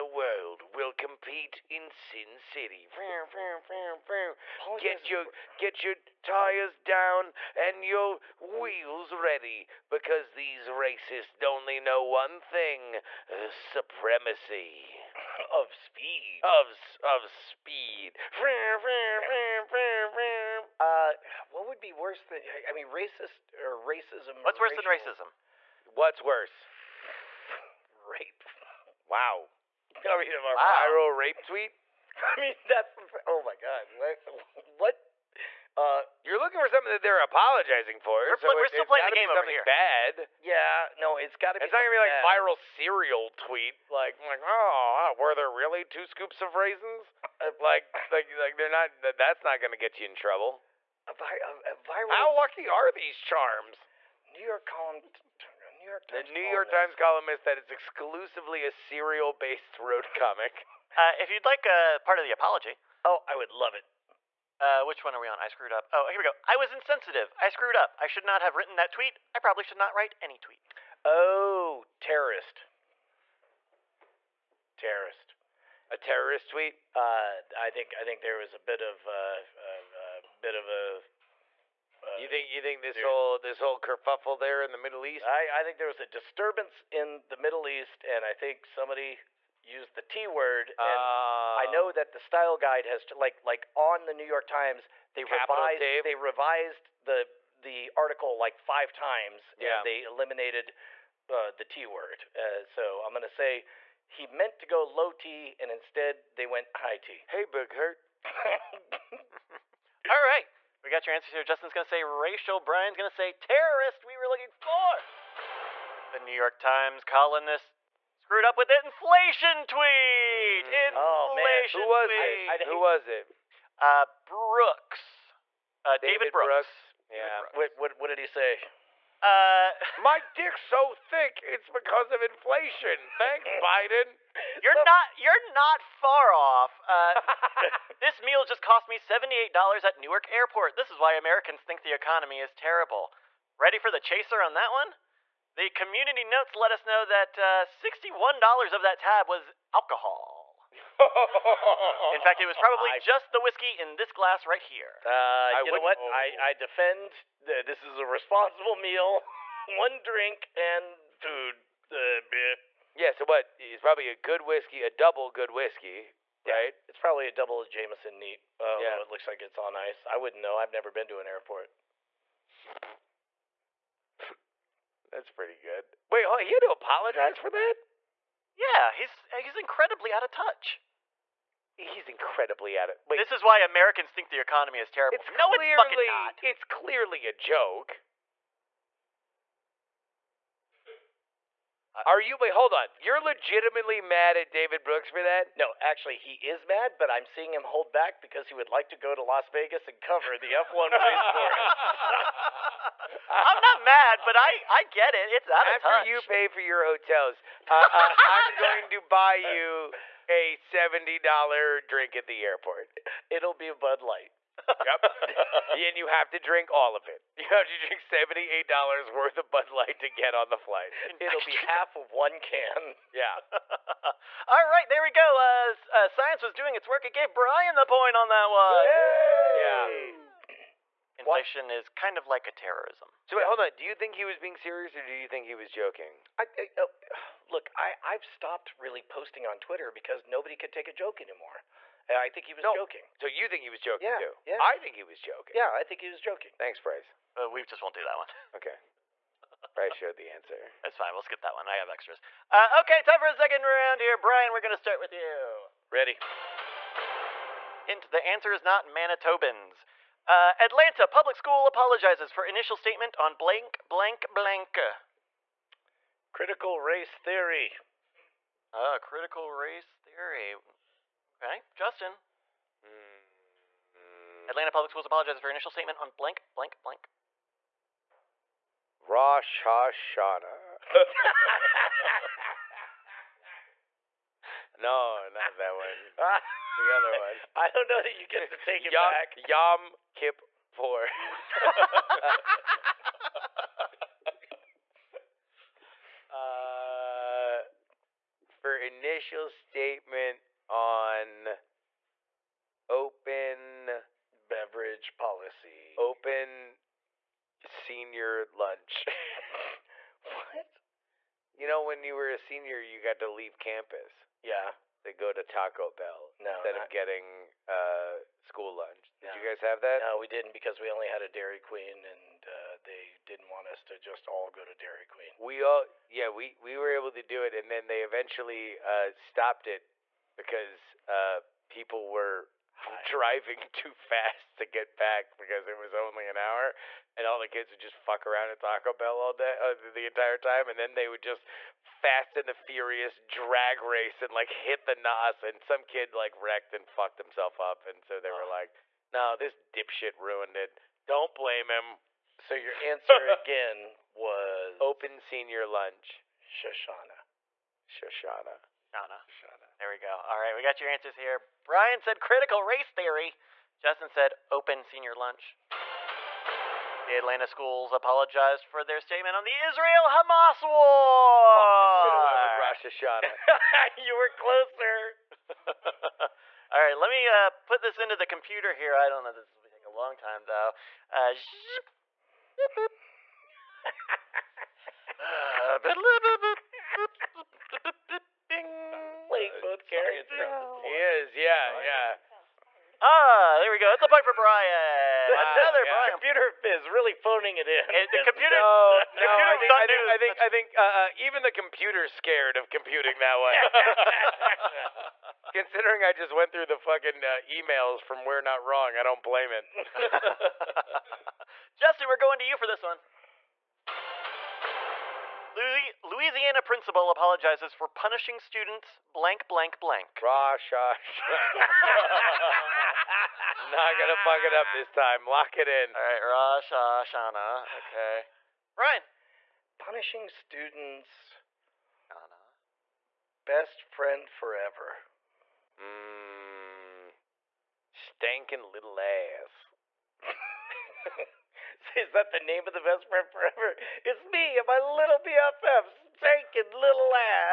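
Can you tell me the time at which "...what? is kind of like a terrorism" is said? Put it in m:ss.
3:51.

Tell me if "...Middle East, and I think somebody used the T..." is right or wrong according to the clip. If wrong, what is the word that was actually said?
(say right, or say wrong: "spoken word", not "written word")
right.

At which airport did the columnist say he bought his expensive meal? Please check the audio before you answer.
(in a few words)
Newark Airport.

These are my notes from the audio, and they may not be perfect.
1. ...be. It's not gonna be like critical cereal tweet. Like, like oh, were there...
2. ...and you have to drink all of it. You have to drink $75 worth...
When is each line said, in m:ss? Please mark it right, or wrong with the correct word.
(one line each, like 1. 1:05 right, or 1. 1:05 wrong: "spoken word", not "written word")
1. 0:41 wrong: "viral", not "critical"
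2. 3:35 wrong: "78", not "75".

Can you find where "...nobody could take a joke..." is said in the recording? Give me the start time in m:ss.
4:00.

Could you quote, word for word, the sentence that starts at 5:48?
were like, "No, this dipshit ruined it.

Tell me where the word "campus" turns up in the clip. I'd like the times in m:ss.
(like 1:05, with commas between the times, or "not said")
5:13.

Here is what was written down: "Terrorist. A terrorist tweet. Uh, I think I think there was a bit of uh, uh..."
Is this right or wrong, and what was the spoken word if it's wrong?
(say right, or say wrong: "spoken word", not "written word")
right.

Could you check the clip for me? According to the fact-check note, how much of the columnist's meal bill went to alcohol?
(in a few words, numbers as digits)
$61.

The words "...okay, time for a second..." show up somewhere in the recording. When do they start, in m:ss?
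4:12.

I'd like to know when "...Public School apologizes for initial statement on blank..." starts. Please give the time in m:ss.
4:21.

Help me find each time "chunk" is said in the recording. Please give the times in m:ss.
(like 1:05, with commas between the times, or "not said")
not said.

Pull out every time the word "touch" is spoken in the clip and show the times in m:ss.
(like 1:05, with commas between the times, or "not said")
3:00, 3:25.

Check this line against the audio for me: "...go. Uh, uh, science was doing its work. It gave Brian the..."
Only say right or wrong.
right.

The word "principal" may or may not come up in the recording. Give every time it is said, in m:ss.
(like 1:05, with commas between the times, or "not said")
6:56.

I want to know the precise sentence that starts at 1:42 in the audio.
Uh, so I'm gonna say he meant to go low T, and instead they went high T.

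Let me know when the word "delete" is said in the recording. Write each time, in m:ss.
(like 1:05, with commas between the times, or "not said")
not said.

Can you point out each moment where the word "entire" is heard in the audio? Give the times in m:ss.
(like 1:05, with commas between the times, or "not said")
5:40.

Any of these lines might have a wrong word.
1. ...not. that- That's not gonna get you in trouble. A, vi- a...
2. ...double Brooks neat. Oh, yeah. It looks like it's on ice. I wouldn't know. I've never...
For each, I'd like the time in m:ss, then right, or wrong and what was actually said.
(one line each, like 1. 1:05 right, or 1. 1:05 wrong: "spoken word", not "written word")
1. 0:48 right
2. 2:47 wrong: "Jameson", not "Brooks".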